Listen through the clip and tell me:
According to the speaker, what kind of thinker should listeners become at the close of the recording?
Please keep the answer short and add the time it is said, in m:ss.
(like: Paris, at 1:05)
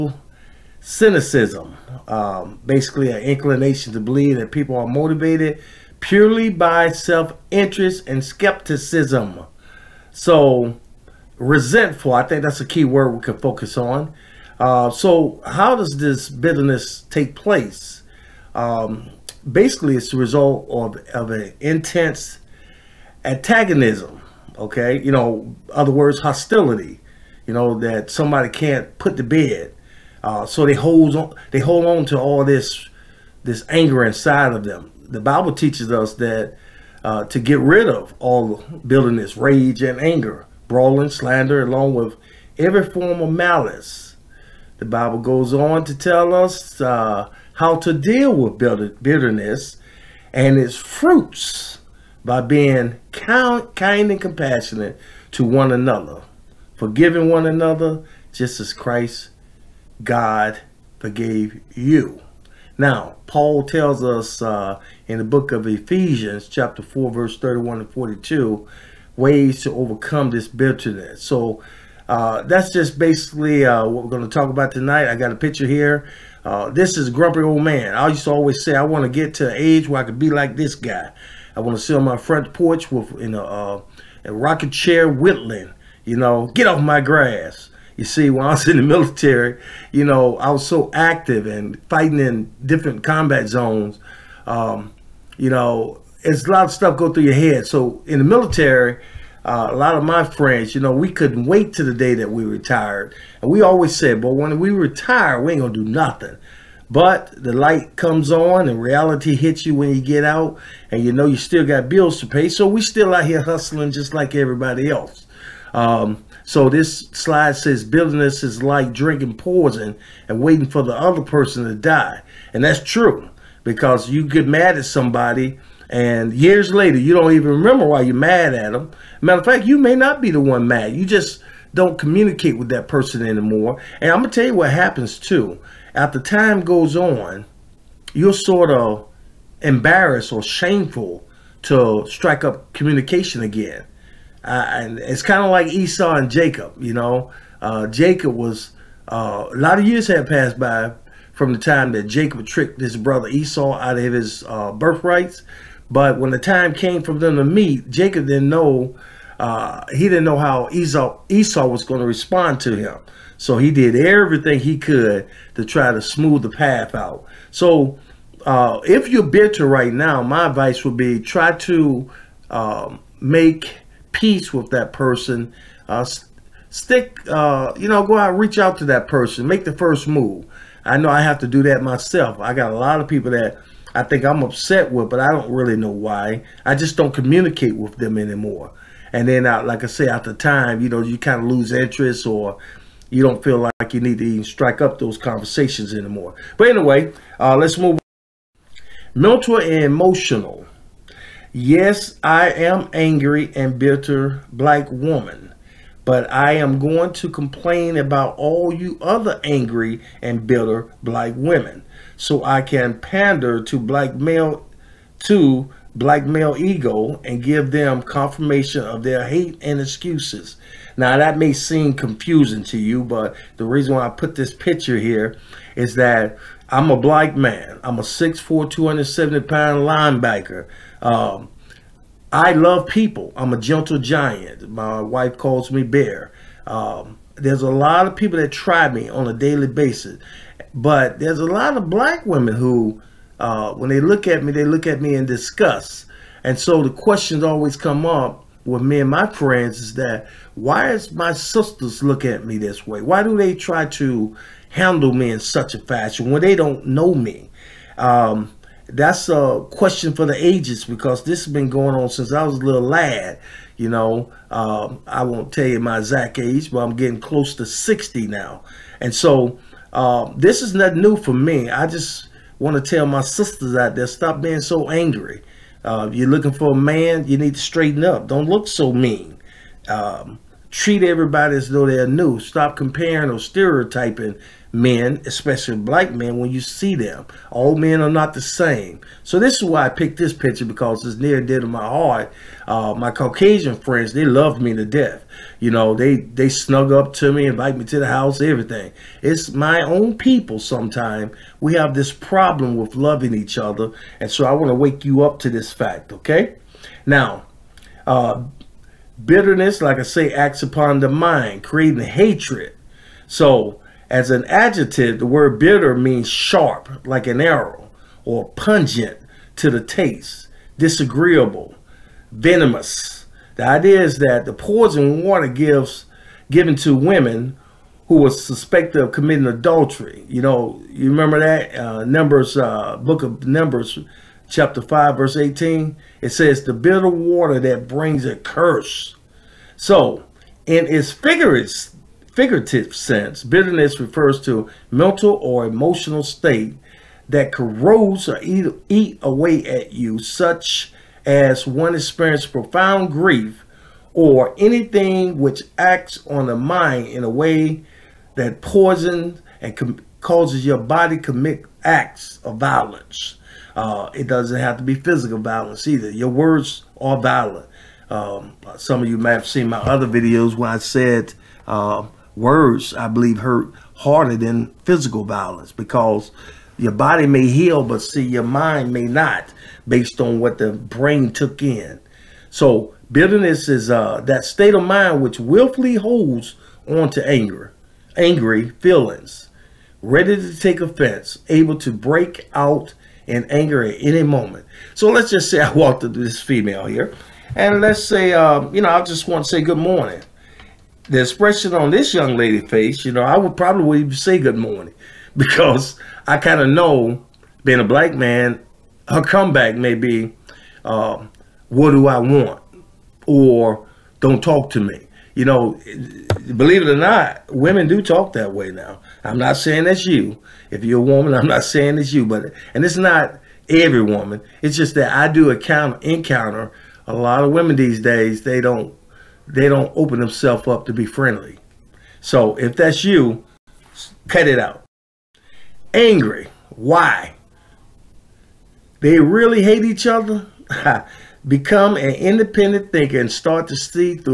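independent thinker, at 7:22.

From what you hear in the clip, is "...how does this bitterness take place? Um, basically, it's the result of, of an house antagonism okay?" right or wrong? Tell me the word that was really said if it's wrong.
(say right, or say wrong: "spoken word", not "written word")
wrong: "intense", not "house".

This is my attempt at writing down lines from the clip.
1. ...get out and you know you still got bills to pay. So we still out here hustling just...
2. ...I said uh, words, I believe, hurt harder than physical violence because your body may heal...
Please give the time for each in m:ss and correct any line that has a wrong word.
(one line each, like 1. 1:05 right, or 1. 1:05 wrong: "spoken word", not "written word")
1. 1:49 right
2. 6:10 right.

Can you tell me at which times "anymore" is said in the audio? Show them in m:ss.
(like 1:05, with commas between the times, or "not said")
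2:13, 3:08, 3:15.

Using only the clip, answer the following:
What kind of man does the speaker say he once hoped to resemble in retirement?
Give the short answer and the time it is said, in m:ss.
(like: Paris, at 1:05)
grumpy old man, at 1:17.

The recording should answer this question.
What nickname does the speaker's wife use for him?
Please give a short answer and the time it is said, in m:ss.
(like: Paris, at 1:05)
bear, at 3:55.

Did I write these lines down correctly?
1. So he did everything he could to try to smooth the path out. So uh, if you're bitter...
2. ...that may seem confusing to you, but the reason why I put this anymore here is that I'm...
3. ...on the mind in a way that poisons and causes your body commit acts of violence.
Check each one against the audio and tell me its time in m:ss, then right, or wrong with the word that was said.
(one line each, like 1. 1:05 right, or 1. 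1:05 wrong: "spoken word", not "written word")
1. 2:43 right
2. 3:41 wrong: "picture", not "anymore"
3. 5:56 right.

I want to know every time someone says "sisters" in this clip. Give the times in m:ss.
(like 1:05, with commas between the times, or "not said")
4:11, 4:33.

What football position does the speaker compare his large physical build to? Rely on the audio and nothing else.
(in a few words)
linebacker.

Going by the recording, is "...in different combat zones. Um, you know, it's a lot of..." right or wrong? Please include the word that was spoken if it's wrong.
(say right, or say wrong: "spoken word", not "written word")
right.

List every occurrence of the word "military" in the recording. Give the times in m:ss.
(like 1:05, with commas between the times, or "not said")
1:28, 1:38.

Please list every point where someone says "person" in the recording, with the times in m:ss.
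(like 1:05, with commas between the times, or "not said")
2:01, 2:12, 2:54, 2:59.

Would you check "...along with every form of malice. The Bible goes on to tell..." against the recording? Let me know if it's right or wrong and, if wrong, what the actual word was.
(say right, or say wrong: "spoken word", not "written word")
right.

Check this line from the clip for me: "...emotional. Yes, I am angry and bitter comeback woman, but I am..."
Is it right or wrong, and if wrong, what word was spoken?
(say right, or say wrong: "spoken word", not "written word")
wrong: "black", not "comeback".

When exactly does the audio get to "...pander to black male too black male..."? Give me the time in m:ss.
3:32.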